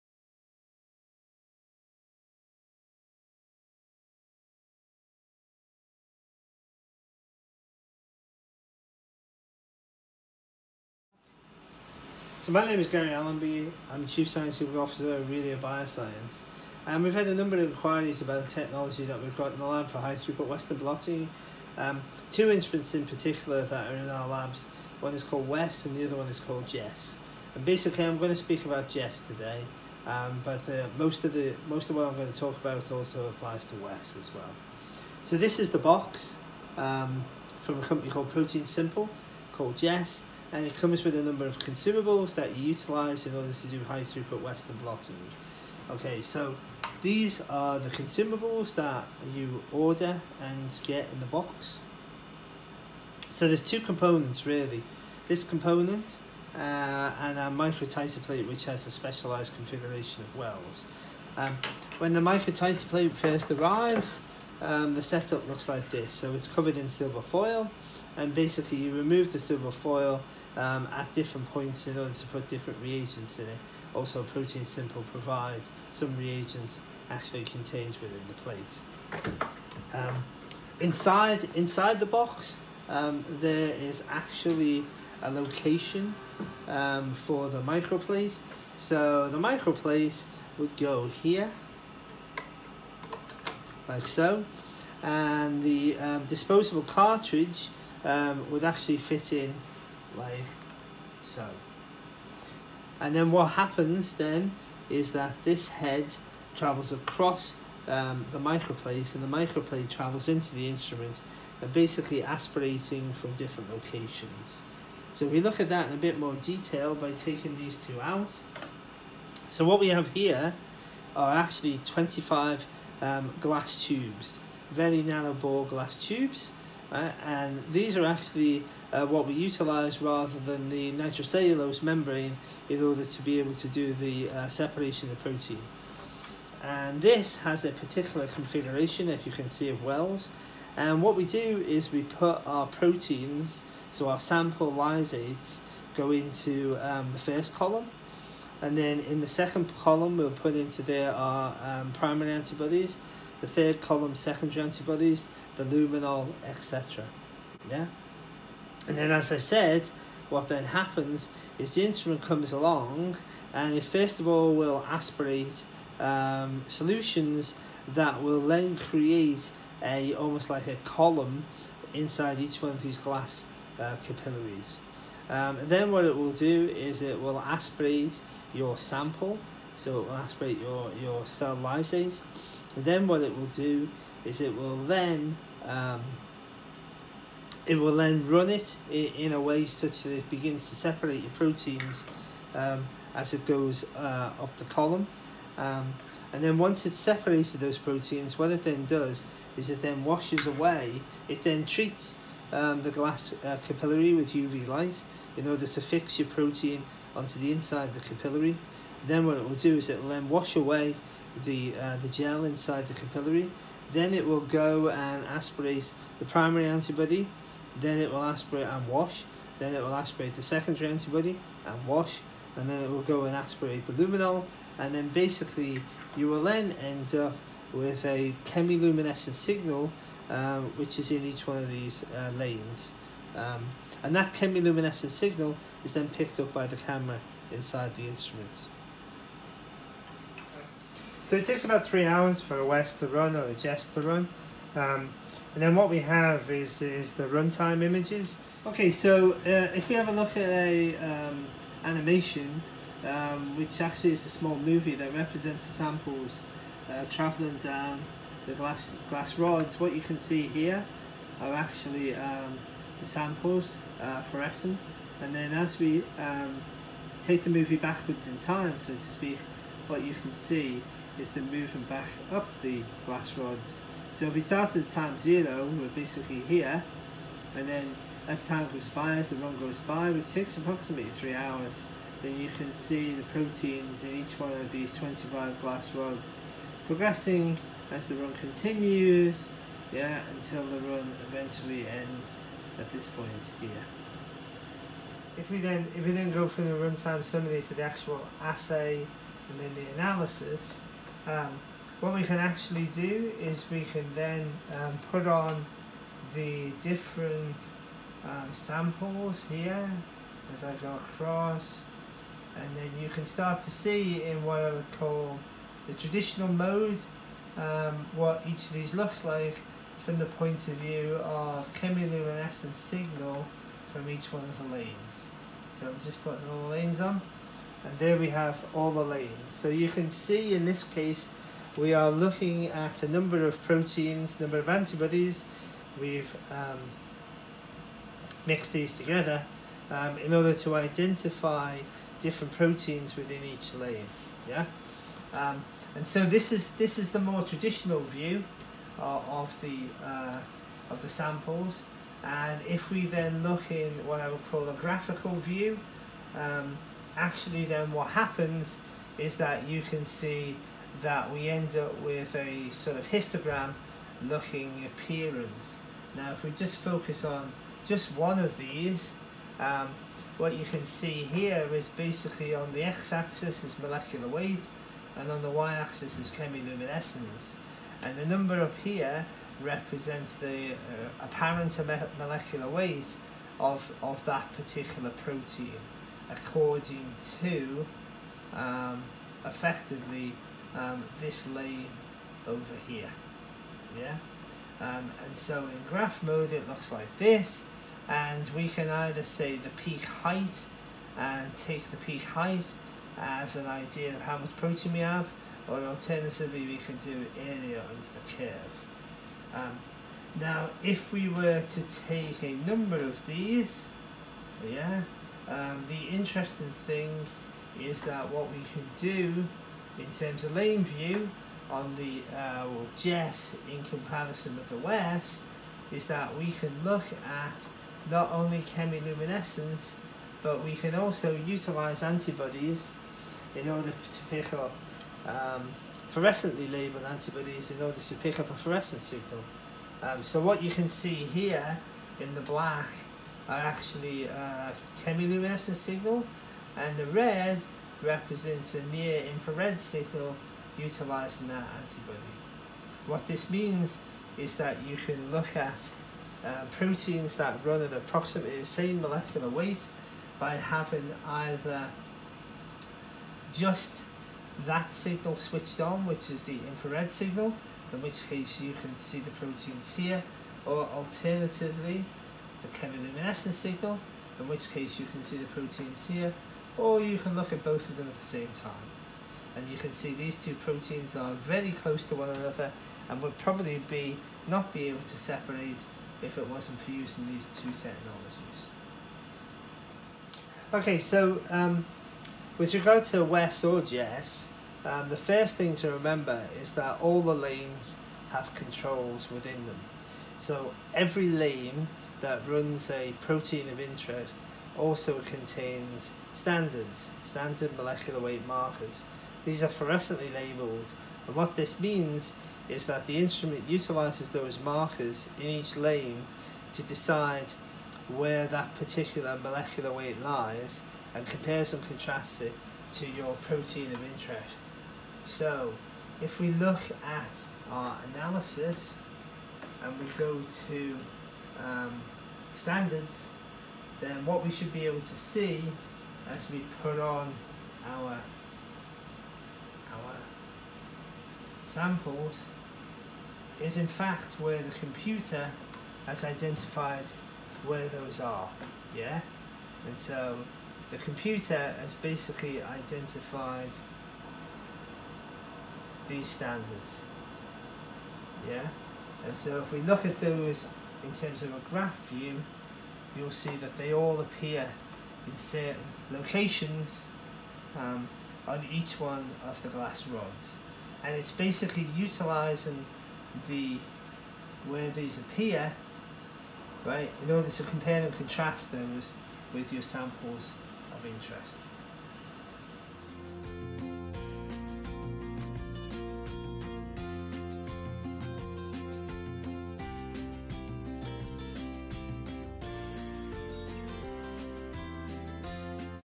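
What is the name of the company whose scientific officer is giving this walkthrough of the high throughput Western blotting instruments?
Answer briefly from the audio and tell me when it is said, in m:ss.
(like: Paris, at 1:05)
Aurelia Bioscience, at 0:15.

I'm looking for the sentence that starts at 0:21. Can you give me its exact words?
Um, two instruments in particular that are in our labs, one is called Wes and the other one is called Jess.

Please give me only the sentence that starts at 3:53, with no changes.
Um, and that chemiluminescent signal is then picked up by the camera inside the instrument.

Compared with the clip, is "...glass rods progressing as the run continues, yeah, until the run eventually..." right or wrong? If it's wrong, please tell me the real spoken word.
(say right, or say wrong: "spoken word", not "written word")
right.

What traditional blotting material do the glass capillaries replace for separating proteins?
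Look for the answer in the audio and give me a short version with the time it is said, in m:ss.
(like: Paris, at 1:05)
nitrocellulose membrane, at 2:10.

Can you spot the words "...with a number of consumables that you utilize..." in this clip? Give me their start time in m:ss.
0:41.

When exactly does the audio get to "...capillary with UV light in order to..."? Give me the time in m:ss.
3:23.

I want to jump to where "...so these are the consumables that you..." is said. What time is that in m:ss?
0:46.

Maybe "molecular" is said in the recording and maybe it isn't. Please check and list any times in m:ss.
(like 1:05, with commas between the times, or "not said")
6:13, 6:22, 7:39, 8:27, 8:39.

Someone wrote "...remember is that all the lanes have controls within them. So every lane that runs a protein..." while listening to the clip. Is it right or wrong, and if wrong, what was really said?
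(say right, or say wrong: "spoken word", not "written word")
right.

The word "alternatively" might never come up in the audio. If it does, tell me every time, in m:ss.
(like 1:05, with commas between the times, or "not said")
6:45, 7:50.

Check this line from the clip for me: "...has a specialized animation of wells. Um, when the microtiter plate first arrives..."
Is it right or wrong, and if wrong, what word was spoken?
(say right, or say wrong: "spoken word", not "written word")
wrong: "configuration", not "animation".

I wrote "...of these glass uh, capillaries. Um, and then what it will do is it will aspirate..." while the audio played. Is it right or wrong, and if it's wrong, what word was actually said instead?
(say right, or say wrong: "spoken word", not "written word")
right.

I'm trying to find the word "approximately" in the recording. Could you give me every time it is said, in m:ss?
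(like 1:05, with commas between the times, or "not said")
4:40, 7:37.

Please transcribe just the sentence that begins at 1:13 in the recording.
Also, ProteinSimple provides some reagents actually contained within the plate.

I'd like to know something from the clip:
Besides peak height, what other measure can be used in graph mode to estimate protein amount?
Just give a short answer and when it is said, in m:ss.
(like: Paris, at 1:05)
area under the curve, at 6:47.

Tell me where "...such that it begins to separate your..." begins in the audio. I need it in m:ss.
3:09.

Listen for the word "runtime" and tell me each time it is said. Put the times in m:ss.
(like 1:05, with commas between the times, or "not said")
4:07, 4:56.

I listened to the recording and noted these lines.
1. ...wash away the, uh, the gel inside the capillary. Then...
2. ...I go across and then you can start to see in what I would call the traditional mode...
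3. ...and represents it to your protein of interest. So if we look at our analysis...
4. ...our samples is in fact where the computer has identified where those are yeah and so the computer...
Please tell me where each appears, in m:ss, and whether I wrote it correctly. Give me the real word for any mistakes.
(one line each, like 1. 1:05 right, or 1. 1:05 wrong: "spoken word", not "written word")
1. 3:30 right
2. 5:10 right
3. 8:41 wrong: "contrasts", not "represents"
4. 8:59 right.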